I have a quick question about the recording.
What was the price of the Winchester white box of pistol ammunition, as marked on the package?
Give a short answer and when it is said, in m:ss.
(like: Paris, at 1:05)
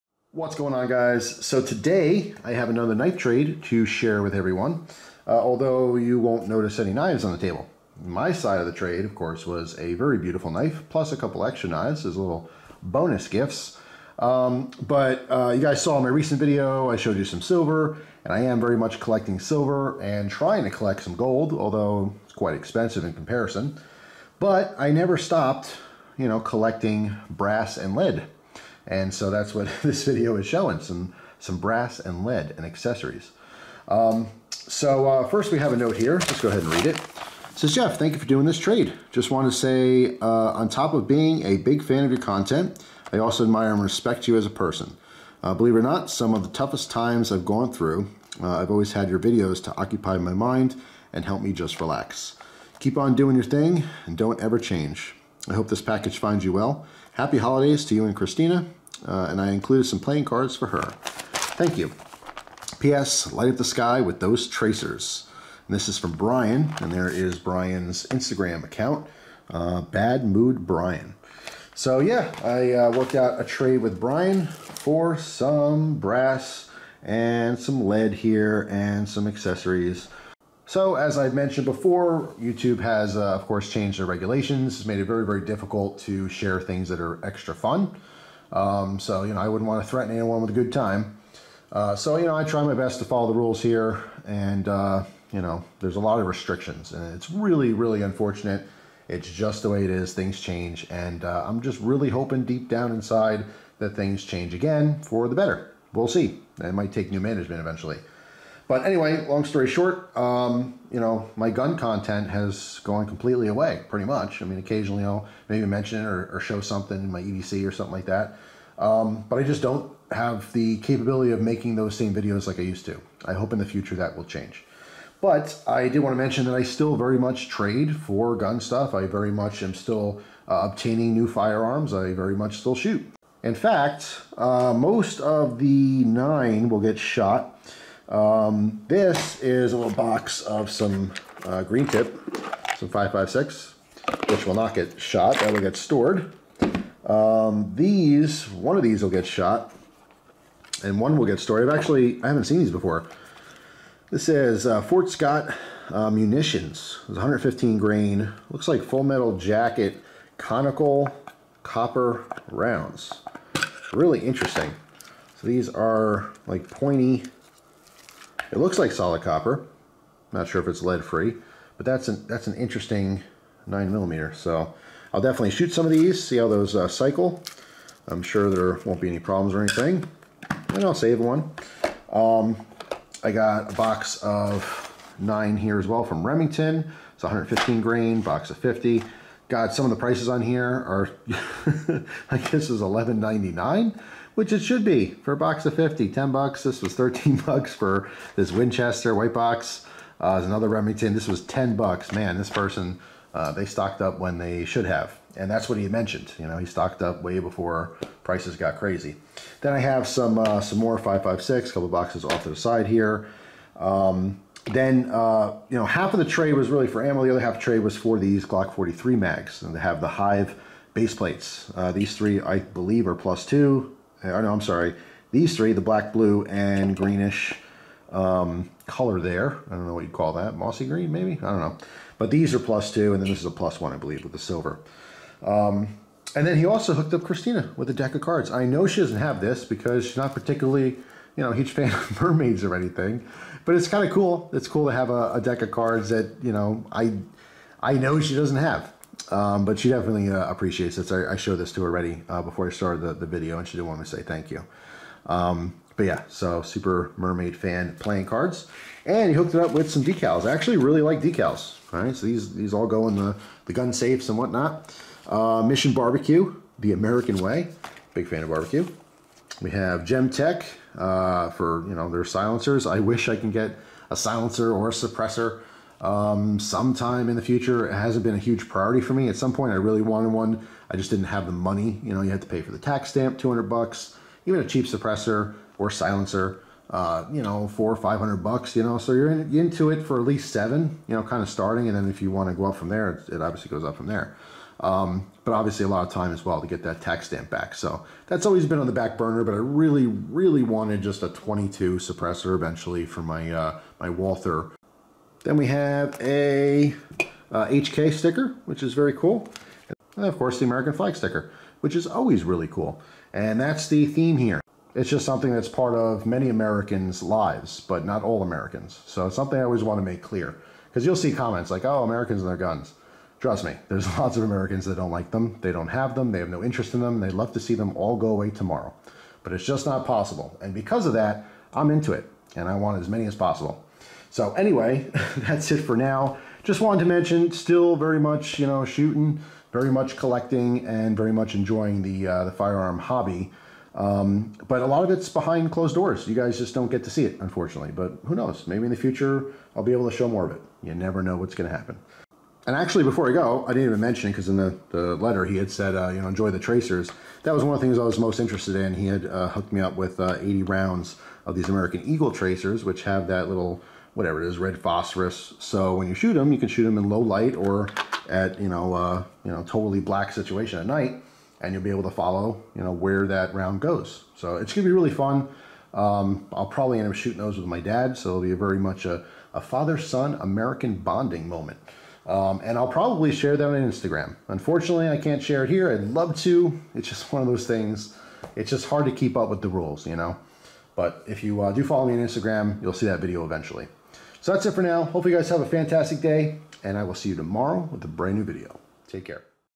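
13 dollars, at 3:16.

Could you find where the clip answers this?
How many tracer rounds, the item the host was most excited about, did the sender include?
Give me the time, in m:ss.
6:00.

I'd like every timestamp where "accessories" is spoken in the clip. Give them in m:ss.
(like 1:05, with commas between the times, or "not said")
0:32, 1:19.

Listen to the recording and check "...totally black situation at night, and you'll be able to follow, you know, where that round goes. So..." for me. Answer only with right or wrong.
right.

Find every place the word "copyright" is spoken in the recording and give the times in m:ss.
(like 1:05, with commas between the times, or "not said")
not said.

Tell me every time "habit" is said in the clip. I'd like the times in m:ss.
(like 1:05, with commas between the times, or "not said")
not said.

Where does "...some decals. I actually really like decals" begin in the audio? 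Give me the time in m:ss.
4:19.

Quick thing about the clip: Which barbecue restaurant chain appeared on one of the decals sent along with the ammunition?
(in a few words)
Mission Barbecue.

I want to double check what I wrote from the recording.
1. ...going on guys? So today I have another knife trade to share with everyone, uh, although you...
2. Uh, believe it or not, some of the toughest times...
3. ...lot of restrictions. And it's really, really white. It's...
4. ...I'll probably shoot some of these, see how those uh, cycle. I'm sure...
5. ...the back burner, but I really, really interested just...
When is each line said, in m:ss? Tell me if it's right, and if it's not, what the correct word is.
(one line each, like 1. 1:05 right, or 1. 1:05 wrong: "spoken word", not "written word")
1. 0:00 right
2. 0:45 right
3. 1:35 wrong: "unfortunate", not "white"
4. 2:55 wrong: "definitely", not "probably"
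5. 4:58 wrong: "wanted", not "interested".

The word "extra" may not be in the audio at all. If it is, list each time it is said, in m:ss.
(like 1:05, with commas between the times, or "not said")
0:11, 1:27.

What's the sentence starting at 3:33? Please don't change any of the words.
Um, then, uh, you know, half of the tray was really for ammo.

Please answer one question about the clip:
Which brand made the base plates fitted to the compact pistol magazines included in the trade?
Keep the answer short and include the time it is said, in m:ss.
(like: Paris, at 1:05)
Hyve, at 3:40.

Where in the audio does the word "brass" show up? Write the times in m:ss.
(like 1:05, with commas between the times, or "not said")
0:27, 0:31, 1:15.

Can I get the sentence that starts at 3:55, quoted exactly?
Um, and then he also hooked up Christina with a deck of cards.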